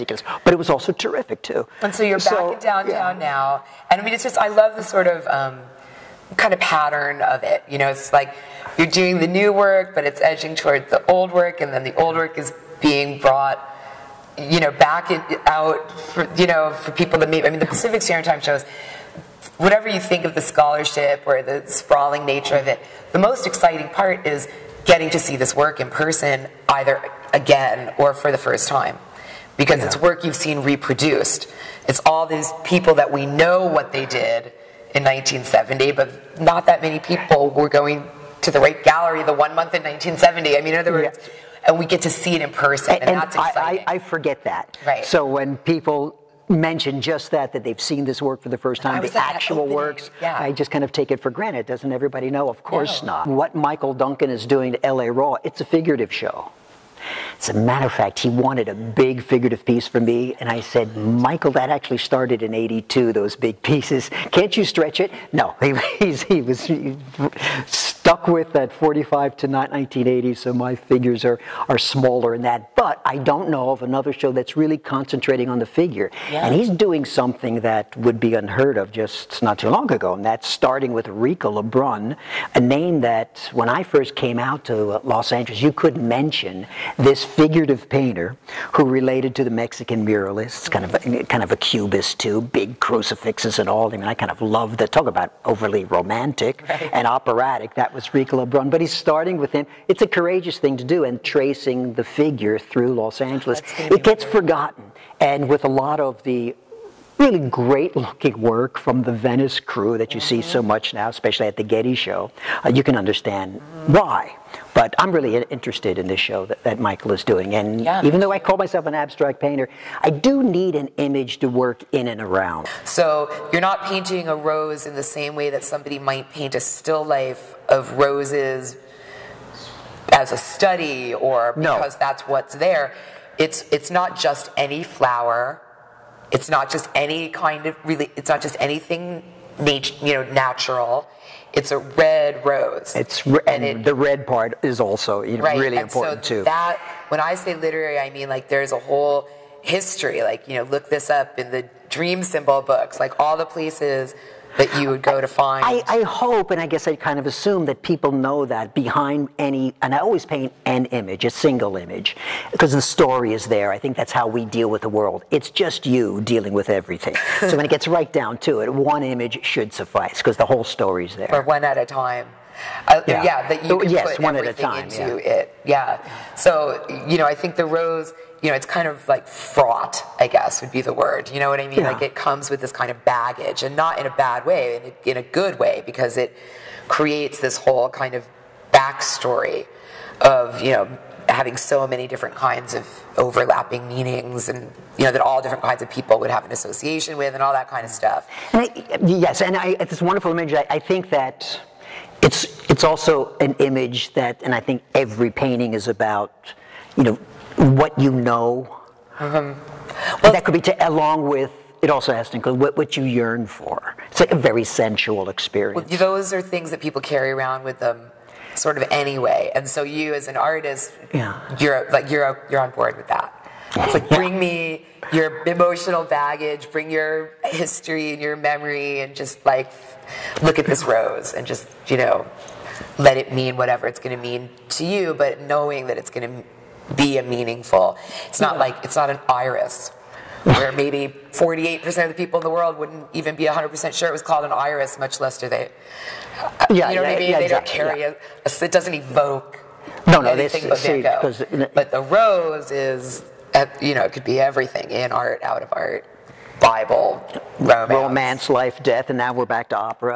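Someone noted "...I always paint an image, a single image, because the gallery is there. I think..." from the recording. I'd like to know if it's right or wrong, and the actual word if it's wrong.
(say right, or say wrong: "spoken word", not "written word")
wrong: "story", not "gallery".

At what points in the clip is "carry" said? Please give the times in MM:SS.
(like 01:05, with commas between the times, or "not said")
03:37, 04:07.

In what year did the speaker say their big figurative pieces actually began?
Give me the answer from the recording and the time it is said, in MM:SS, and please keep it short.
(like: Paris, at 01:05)
1982, at 01:02.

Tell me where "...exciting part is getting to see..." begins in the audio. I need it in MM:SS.
00:23.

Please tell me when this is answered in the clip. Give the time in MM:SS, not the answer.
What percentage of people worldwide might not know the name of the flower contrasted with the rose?
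04:01.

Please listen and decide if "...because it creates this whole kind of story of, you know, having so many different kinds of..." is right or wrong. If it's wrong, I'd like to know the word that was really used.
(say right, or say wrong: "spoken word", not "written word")
wrong: "backstory", not "story".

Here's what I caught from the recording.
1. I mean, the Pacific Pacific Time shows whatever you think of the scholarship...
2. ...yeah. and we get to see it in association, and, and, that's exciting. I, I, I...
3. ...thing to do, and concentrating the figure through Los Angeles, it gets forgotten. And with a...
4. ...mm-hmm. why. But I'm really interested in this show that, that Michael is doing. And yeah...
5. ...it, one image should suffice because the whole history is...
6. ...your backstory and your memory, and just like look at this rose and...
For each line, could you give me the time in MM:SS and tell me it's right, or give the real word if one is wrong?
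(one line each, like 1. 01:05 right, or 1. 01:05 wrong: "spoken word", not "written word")
1. 00:17 wrong: "Standard", not "Pacific"
2. 00:41 wrong: "person", not "association"
3. 01:40 wrong: "tracing", not "concentrating"
4. 01:53 right
5. 02:48 wrong: "story", not "history"
6. 03:46 wrong: "history", not "backstory".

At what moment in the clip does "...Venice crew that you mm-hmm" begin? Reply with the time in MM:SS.
01:49.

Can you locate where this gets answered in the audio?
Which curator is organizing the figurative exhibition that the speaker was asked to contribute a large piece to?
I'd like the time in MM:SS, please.
00:53.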